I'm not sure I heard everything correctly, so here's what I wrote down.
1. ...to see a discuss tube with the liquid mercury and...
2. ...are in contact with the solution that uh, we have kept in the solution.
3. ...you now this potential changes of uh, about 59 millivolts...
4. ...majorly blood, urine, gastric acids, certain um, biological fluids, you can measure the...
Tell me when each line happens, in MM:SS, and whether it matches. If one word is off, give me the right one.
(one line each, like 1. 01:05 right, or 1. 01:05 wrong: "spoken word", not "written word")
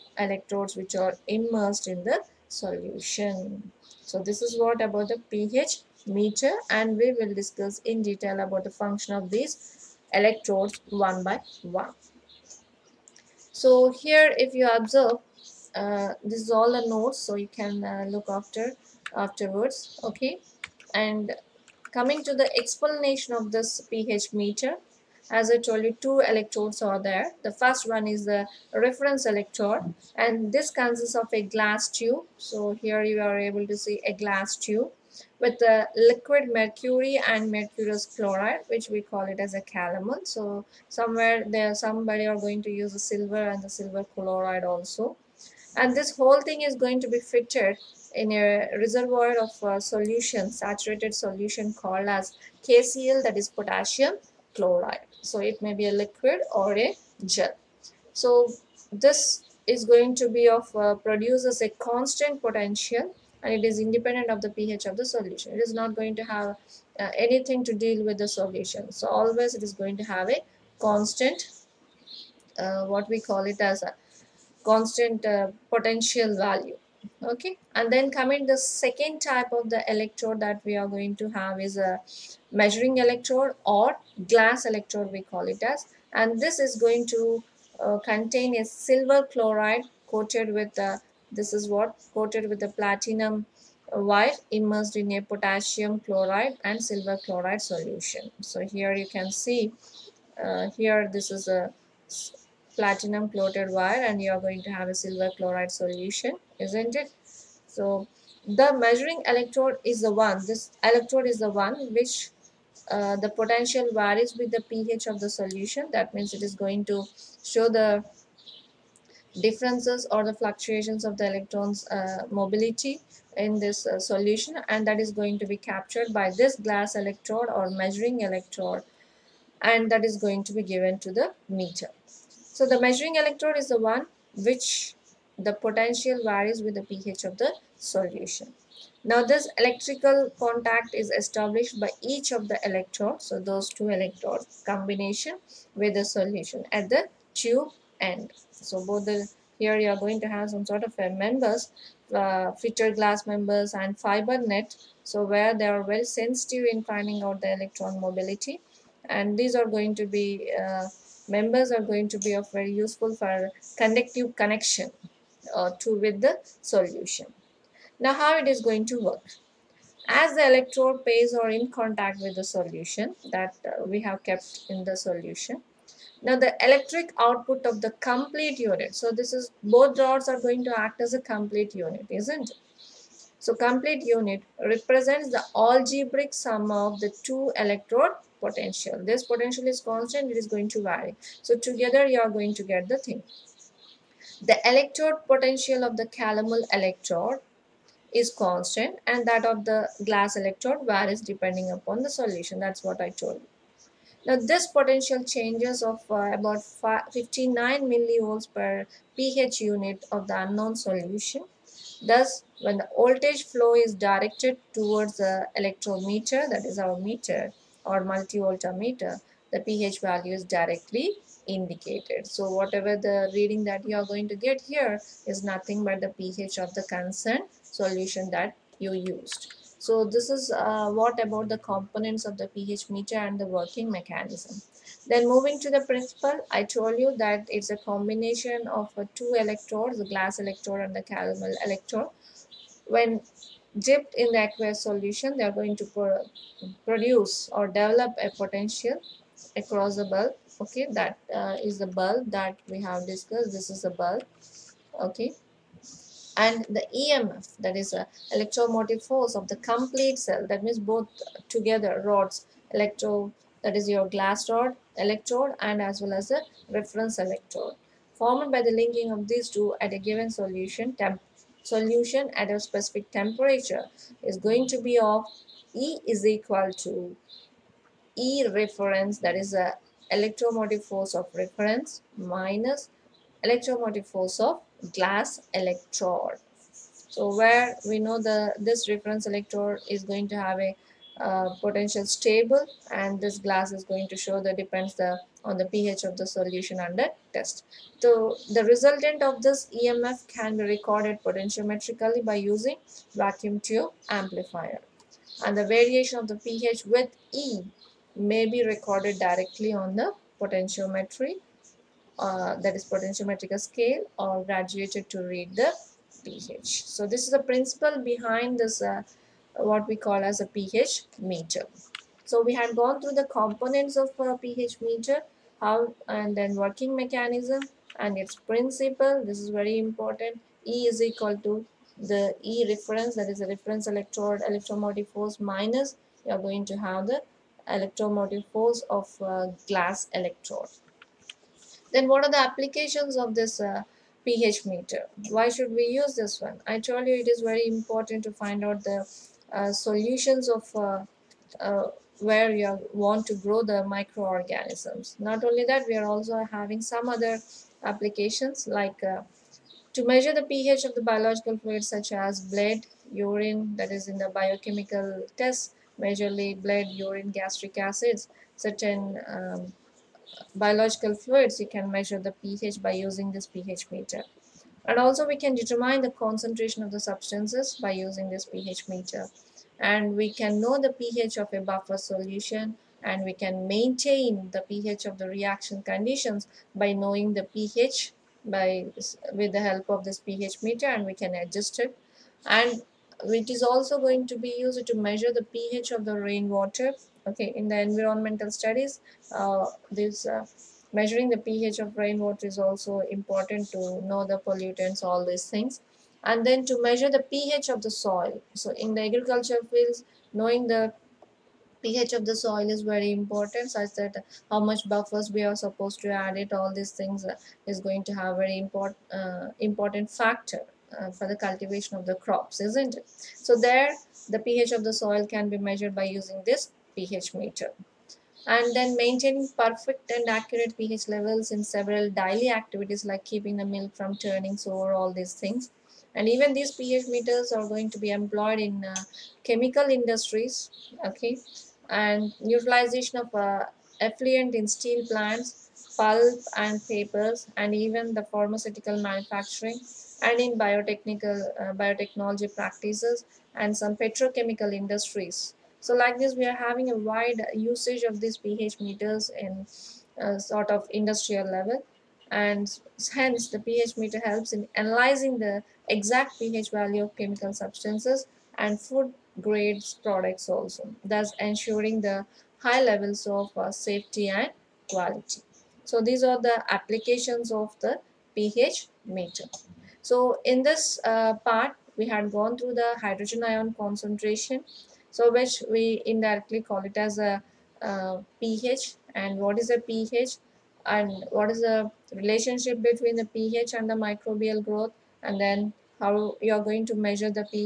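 1. 00:33 wrong: "glass", not "discuss"
2. 02:51 right
3. 03:23 right
4. 06:05 right.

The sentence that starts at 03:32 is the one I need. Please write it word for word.
Thus, when the voltage flow is directed towards the electrometer, that is our meter, or meter, the pH value is directly indicated.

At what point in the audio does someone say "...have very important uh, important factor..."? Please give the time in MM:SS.
06:58.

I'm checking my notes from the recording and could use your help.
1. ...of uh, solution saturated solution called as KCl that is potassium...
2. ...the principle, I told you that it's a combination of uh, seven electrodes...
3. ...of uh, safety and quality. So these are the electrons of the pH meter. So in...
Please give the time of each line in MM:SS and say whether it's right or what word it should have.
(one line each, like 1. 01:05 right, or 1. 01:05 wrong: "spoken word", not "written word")
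1. 00:49 right
2. 03:55 wrong: "two", not "seven"
3. 07:53 wrong: "applications", not "electrons".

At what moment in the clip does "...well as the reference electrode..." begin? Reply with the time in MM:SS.
04:26.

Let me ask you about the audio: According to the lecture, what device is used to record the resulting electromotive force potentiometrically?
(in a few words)
vacuum tube amplifier.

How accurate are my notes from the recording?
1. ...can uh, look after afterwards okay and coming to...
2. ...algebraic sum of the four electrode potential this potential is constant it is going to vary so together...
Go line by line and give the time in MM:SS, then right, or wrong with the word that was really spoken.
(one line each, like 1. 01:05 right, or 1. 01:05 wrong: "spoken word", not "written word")
1. 00:17 right
2. 03:05 wrong: "two", not "four".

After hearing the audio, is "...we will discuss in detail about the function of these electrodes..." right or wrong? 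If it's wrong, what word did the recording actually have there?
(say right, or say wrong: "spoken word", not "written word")
right.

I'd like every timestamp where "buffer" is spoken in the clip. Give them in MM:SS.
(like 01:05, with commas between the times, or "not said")
06:21, 06:54.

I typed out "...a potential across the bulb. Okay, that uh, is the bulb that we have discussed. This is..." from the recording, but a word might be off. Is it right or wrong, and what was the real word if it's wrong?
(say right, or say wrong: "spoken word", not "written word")
right.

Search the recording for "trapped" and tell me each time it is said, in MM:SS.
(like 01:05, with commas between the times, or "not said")
not said.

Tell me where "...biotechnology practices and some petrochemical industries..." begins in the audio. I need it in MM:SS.
07:31.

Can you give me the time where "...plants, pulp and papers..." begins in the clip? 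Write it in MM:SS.
07:25.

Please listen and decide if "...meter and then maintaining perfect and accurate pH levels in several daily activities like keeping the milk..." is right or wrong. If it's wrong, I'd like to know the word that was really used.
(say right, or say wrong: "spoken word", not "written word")
right.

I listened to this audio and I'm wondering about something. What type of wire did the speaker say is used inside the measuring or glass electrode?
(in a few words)
platinum wire.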